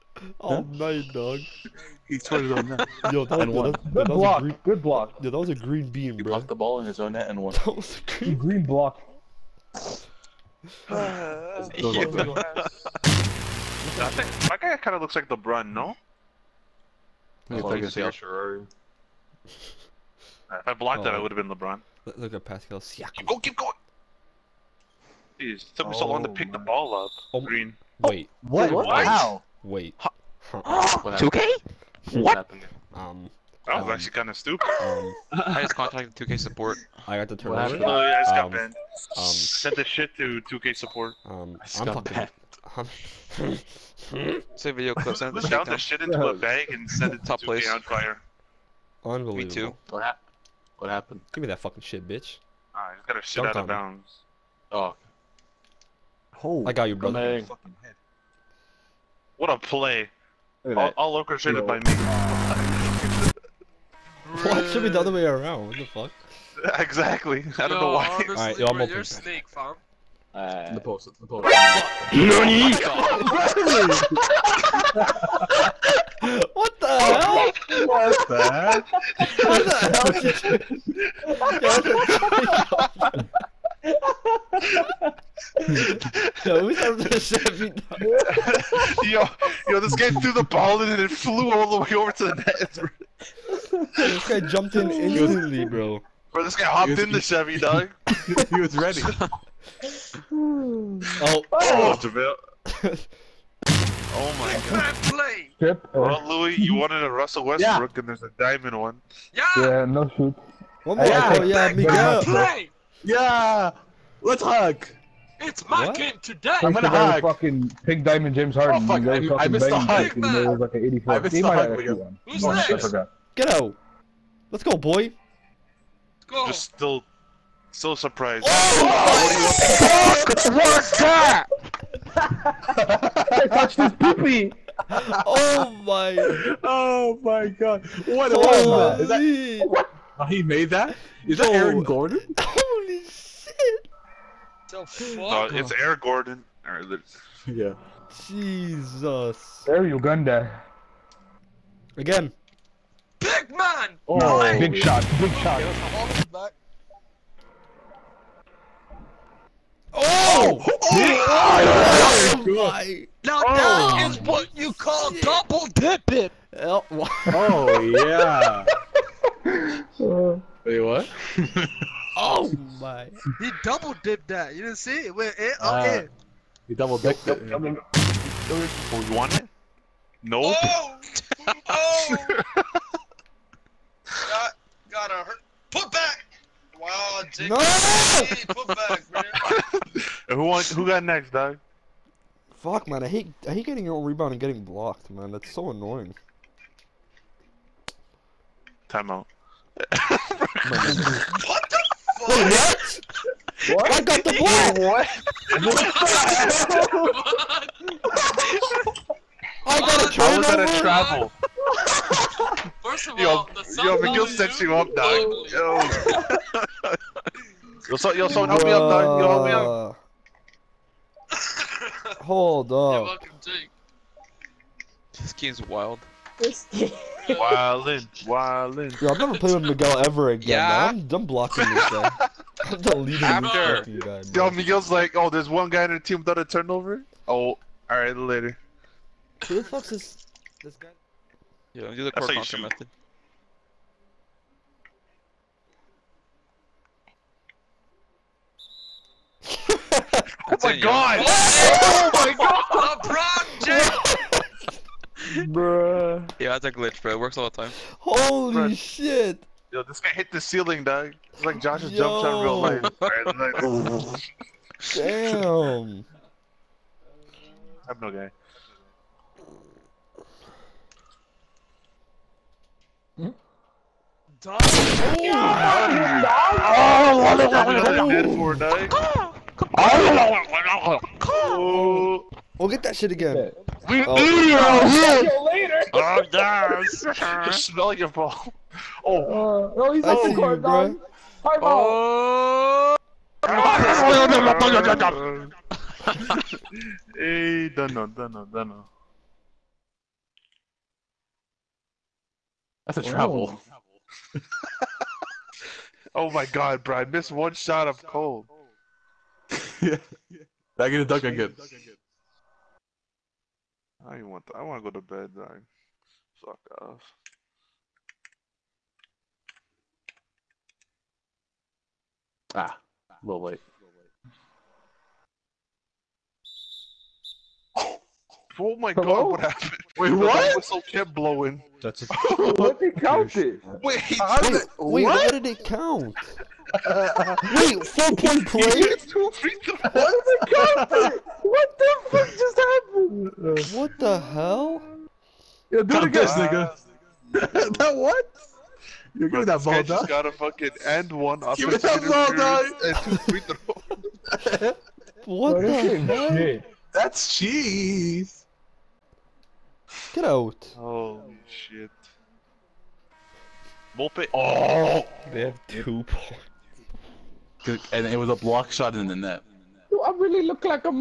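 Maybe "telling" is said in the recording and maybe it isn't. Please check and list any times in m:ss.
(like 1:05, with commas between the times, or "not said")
not said.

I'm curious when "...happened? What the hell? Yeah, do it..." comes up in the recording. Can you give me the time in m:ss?
5:42.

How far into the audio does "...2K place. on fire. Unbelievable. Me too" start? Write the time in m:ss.
0:47.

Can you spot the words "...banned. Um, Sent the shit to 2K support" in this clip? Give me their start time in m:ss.
0:38.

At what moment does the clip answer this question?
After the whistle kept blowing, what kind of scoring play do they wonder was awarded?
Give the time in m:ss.
5:37.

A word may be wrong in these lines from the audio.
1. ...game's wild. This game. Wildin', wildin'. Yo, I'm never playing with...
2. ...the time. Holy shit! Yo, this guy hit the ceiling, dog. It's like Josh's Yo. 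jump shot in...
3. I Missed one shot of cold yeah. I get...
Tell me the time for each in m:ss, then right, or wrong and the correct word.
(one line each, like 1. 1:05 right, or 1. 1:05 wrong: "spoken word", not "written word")
1. 3:45 right
2. 4:17 right
3. 5:06 right.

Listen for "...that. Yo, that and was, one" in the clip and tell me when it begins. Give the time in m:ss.
0:02.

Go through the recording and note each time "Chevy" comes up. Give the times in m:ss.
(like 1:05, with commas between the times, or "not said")
1:27, 1:37.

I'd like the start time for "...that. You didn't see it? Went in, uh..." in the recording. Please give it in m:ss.
2:54.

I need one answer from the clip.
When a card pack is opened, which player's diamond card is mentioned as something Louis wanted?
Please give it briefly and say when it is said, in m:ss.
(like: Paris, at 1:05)
Russell Westbrook, at 1:47.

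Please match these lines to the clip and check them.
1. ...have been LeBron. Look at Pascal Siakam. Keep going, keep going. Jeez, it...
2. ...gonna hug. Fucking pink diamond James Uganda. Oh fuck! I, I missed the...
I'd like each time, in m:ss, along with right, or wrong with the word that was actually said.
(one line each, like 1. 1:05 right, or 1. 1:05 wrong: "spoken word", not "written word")
1. 0:21 right
2. 1:56 wrong: "Harden", not "Uganda".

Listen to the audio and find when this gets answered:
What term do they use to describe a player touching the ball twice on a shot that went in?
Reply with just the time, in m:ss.
2:45.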